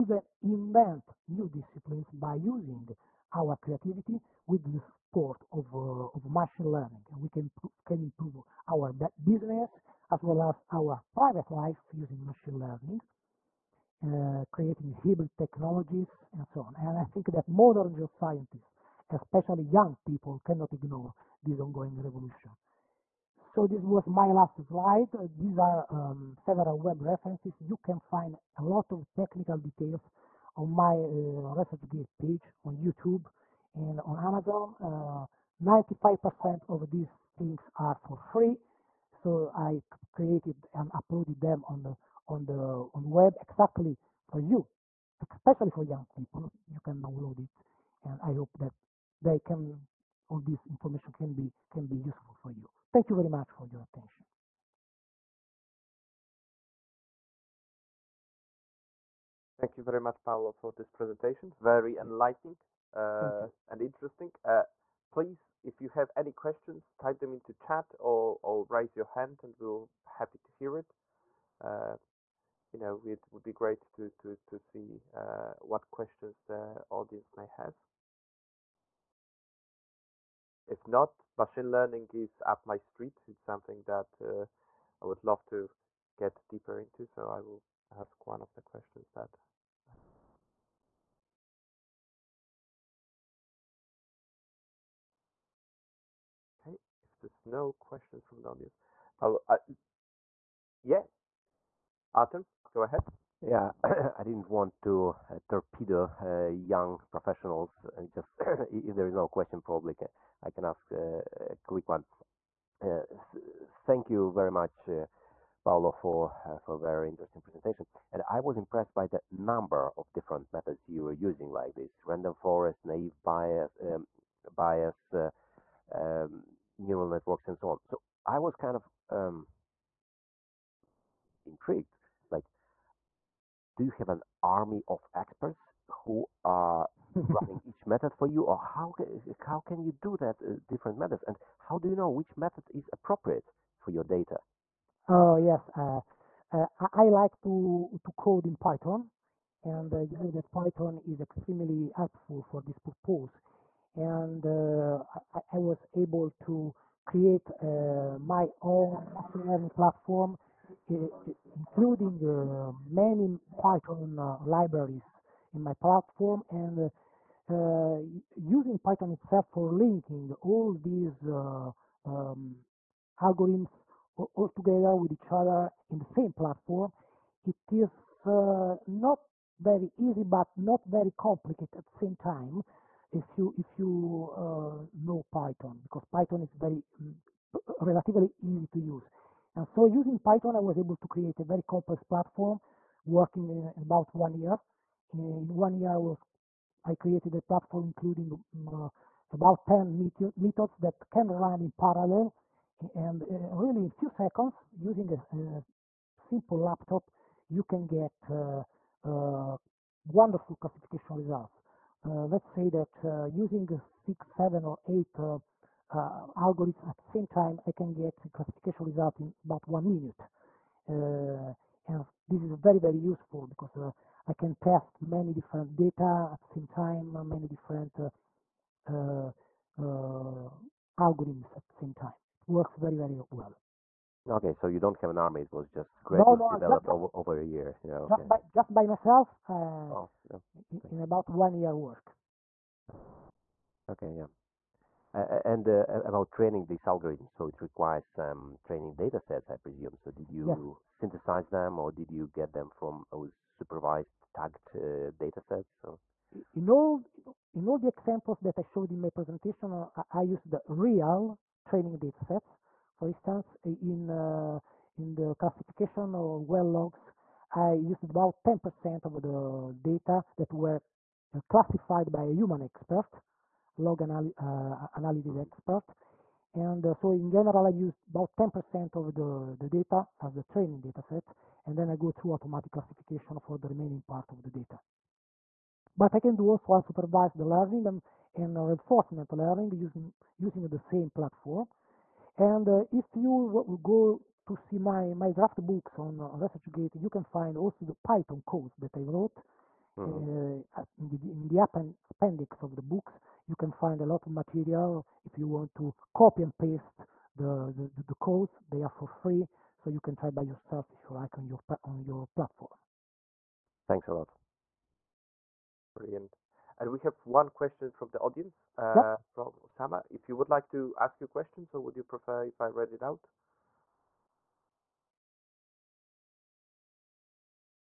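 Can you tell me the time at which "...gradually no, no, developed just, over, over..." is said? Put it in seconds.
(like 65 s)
236 s.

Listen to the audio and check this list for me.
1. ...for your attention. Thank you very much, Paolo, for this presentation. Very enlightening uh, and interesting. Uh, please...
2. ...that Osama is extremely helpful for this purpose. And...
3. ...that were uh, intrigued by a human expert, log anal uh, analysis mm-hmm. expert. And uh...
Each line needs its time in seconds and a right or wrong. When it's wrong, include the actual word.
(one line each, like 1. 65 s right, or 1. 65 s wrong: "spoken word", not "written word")
1. 53 s right
2. 150 s wrong: "Python", not "Osama"
3. 270 s wrong: "classified", not "intrigued".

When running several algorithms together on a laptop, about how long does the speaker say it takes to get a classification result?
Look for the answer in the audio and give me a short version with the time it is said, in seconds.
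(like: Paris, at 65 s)
About one minute, at 219 s.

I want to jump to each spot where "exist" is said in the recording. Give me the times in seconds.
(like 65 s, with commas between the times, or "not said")
not said.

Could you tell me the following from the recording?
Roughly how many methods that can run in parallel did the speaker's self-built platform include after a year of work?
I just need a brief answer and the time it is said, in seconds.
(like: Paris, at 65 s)
About 10, at 199 s.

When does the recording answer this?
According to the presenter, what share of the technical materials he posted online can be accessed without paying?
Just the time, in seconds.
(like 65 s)
35 s.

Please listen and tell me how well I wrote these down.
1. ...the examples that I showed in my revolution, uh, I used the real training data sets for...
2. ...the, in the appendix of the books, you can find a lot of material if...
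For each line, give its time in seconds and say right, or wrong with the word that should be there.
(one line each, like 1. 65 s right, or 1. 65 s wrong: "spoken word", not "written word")
1. 257 s wrong: "presentation", not "revolution"
2. 301 s right.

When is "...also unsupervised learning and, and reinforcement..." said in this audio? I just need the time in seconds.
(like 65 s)
286 s.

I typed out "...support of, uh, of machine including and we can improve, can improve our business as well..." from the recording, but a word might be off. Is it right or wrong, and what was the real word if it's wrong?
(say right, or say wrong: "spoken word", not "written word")
wrong: "learning", not "including".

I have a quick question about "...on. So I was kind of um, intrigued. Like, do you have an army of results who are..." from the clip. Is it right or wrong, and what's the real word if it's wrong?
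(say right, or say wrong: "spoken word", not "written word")
wrong: "experts", not "results".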